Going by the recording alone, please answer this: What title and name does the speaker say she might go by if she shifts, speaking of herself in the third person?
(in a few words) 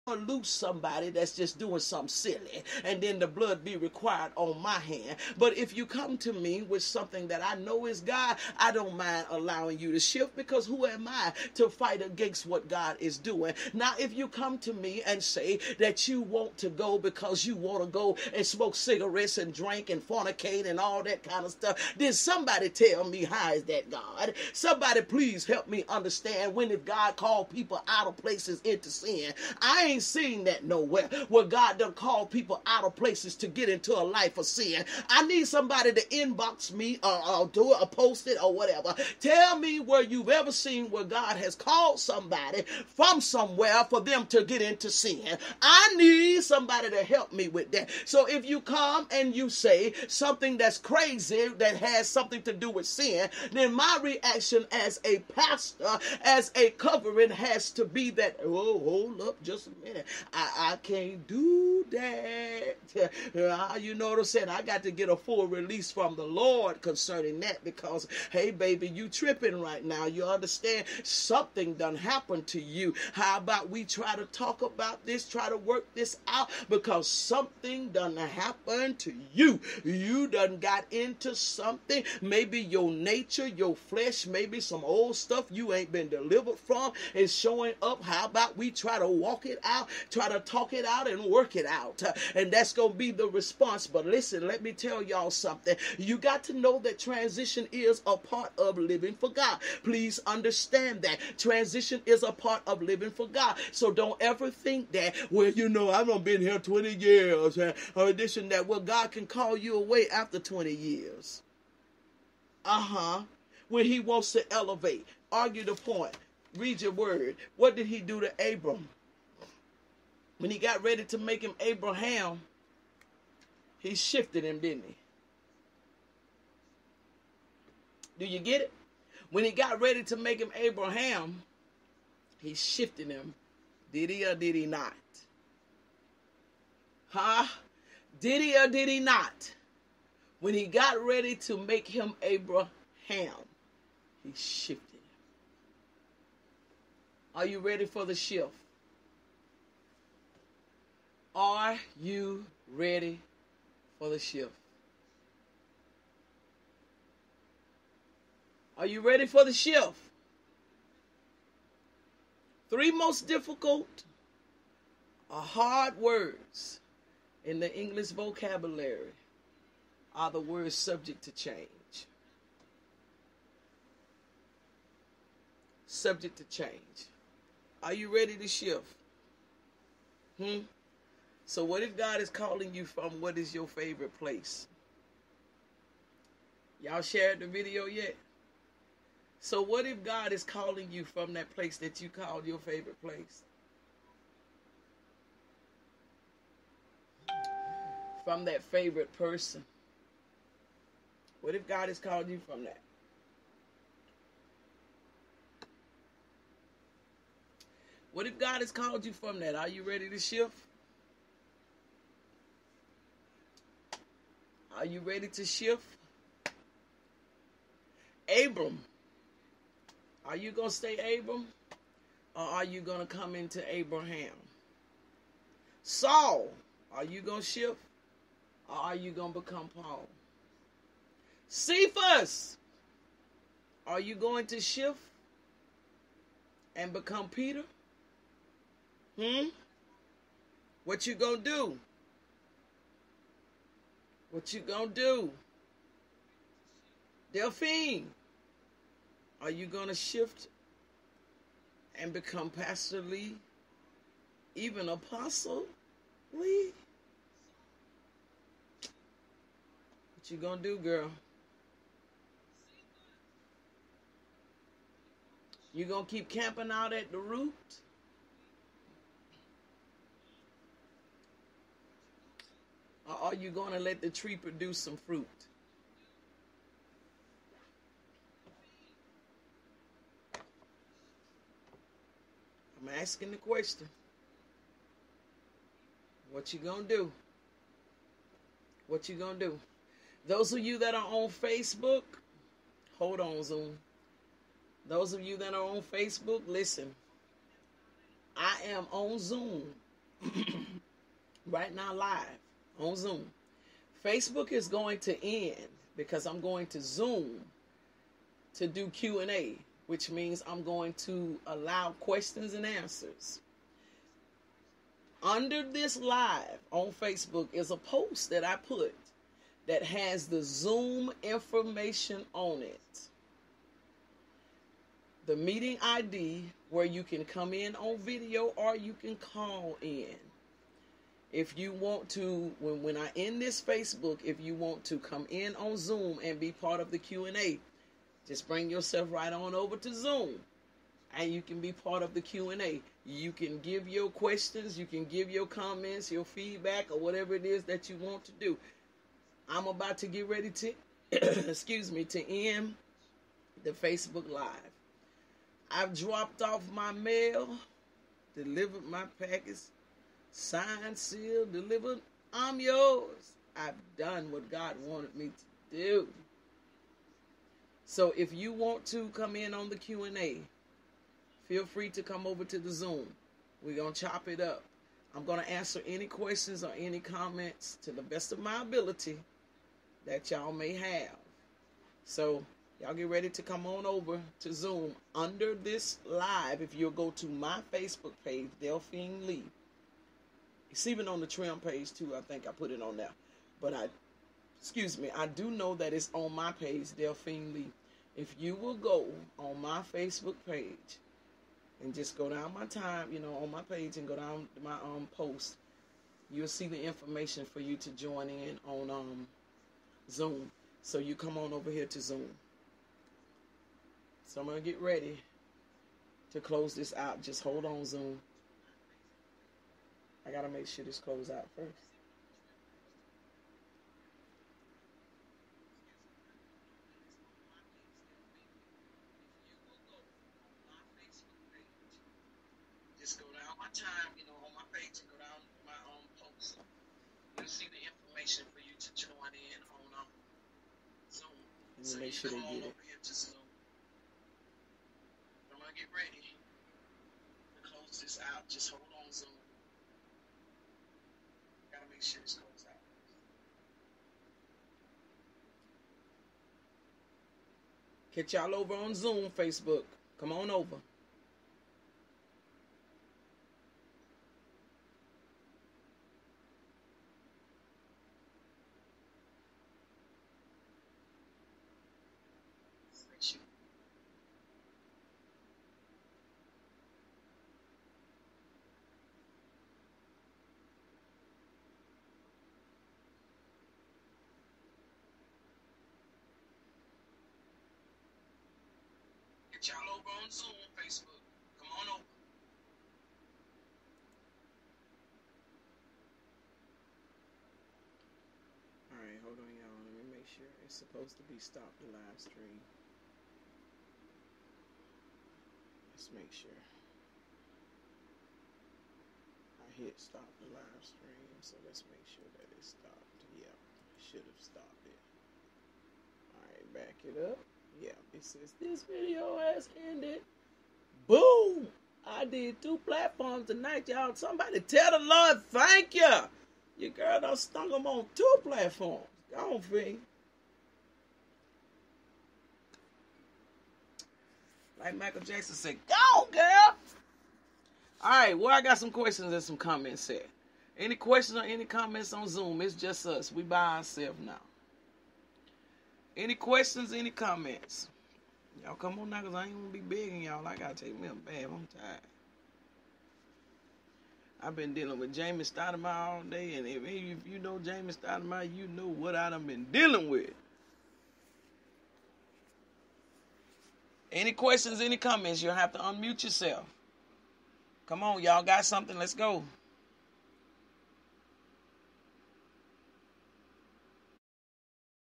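Apostle Lee.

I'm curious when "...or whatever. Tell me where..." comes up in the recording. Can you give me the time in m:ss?
0:38.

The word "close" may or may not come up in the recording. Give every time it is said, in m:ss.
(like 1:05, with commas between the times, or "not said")
6:56, 7:27.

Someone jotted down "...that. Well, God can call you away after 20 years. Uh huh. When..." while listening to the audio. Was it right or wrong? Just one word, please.
right.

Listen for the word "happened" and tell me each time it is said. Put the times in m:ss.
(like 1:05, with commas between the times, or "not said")
1:11, 1:18.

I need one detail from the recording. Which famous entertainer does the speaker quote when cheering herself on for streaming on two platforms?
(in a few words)
Michael Jackson.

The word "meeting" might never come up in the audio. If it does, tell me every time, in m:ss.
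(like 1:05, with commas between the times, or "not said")
5:25.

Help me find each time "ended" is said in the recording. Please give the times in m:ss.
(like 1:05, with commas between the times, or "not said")
8:39.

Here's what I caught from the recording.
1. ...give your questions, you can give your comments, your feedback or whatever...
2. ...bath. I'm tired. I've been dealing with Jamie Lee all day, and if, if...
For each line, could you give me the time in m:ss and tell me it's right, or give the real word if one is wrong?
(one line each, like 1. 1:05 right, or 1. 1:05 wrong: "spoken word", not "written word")
1. 5:43 right
2. 9:11 wrong: "Stoudemire", not "Lee".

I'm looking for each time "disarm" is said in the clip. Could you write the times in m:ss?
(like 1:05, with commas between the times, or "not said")
not said.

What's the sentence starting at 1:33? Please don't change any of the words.
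But listen, let me tell y'all something.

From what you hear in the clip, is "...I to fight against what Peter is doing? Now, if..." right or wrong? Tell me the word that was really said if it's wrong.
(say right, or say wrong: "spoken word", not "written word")
wrong: "God", not "Peter".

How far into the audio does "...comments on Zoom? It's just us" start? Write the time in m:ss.
9:01.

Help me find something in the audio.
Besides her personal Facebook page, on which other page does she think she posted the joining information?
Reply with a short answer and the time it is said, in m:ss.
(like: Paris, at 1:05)
TREM page, at 6:31.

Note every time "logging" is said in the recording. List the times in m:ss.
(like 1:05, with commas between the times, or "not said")
not said.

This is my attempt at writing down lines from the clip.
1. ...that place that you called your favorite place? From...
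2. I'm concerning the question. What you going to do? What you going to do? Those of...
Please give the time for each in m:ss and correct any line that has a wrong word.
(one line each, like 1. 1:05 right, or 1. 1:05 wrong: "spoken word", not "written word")
1. 3:11 right
2. 4:42 wrong: "asking", not "concerning".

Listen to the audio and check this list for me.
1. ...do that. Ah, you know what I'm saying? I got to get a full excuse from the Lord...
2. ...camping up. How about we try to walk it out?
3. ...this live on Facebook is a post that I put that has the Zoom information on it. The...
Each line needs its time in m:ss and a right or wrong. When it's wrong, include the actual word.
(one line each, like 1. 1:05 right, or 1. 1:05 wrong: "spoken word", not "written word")
1. 1:01 wrong: "release", not "excuse"
2. 1:27 wrong: "showing", not "camping"
3. 5:15 right.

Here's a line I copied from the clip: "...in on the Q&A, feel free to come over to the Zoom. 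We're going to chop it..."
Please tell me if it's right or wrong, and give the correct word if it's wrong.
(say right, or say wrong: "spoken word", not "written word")
right.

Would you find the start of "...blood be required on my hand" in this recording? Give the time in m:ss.
0:03.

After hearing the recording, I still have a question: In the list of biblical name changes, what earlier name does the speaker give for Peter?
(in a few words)
Cephas.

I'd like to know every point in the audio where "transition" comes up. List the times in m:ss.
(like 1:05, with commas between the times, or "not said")
1:36, 1:41.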